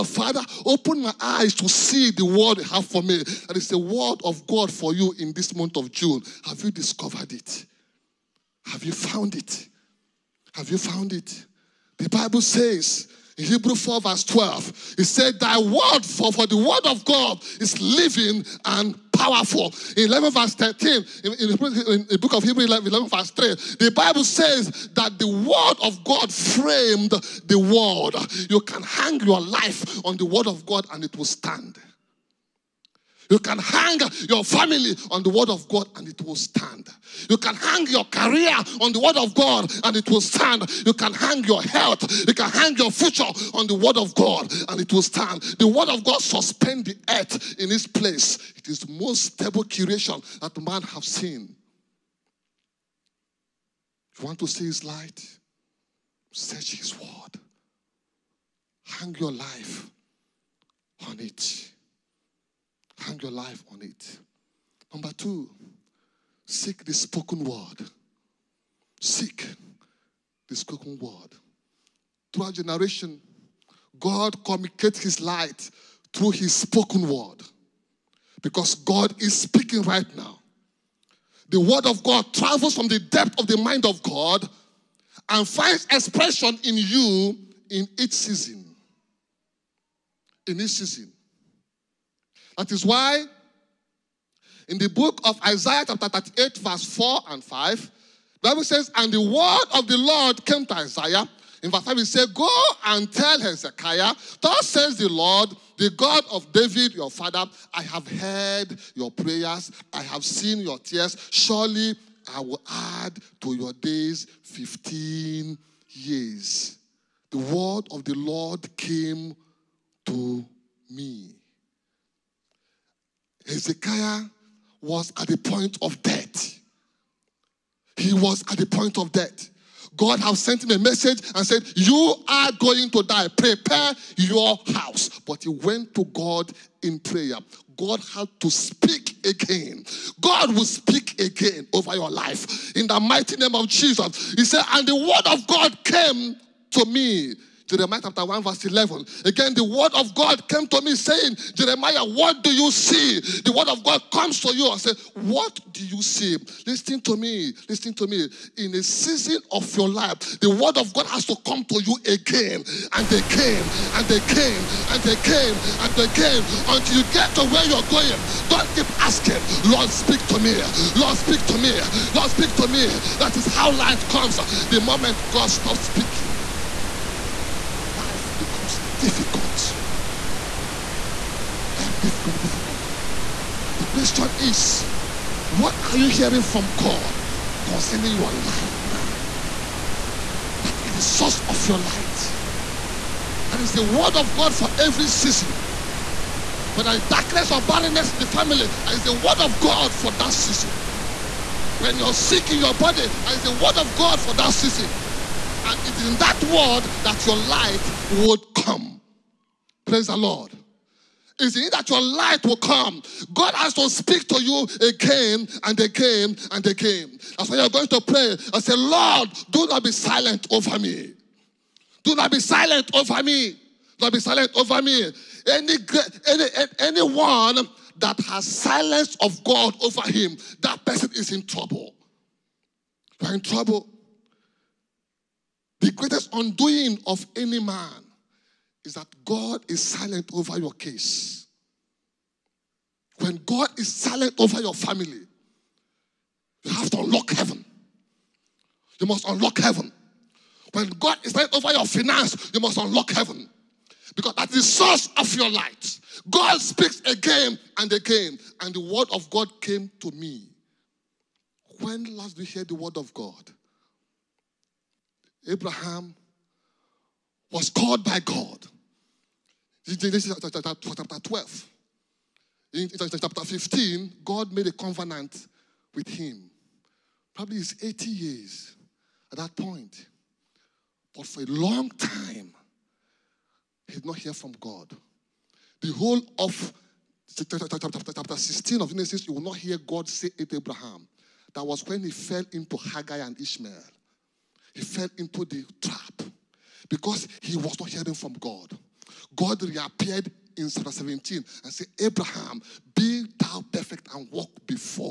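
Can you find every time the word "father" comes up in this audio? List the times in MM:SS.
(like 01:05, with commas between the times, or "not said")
00:00, 01:47.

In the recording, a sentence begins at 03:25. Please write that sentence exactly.
And it is in that word that your light would come.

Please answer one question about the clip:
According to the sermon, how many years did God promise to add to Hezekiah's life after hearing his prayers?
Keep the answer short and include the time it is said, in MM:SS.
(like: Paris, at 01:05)
15, at 01:54.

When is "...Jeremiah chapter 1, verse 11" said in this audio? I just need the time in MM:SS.
02:27.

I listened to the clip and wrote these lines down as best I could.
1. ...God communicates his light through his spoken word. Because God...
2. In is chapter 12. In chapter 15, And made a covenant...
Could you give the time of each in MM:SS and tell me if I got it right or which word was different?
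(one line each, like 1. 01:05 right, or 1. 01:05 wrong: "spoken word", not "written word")
1. 01:13 right
2. 04:29 wrong: "God", not "And".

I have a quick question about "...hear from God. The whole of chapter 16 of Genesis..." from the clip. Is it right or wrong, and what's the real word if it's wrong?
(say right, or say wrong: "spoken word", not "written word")
right.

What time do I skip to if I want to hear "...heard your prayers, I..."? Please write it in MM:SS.
01:48.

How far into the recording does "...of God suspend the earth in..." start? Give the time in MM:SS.
00:45.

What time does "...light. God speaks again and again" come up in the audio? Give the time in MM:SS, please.
04:15.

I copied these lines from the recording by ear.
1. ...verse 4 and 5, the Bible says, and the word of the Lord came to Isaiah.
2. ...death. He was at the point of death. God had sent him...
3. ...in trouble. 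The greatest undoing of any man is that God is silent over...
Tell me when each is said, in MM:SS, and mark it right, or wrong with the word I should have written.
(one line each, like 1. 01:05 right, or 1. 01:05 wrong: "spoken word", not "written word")
1. 01:36 right
2. 02:06 right
3. 03:53 right.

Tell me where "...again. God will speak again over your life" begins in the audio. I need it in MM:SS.
02:19.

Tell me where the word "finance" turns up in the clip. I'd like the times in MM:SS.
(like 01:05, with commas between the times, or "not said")
04:11.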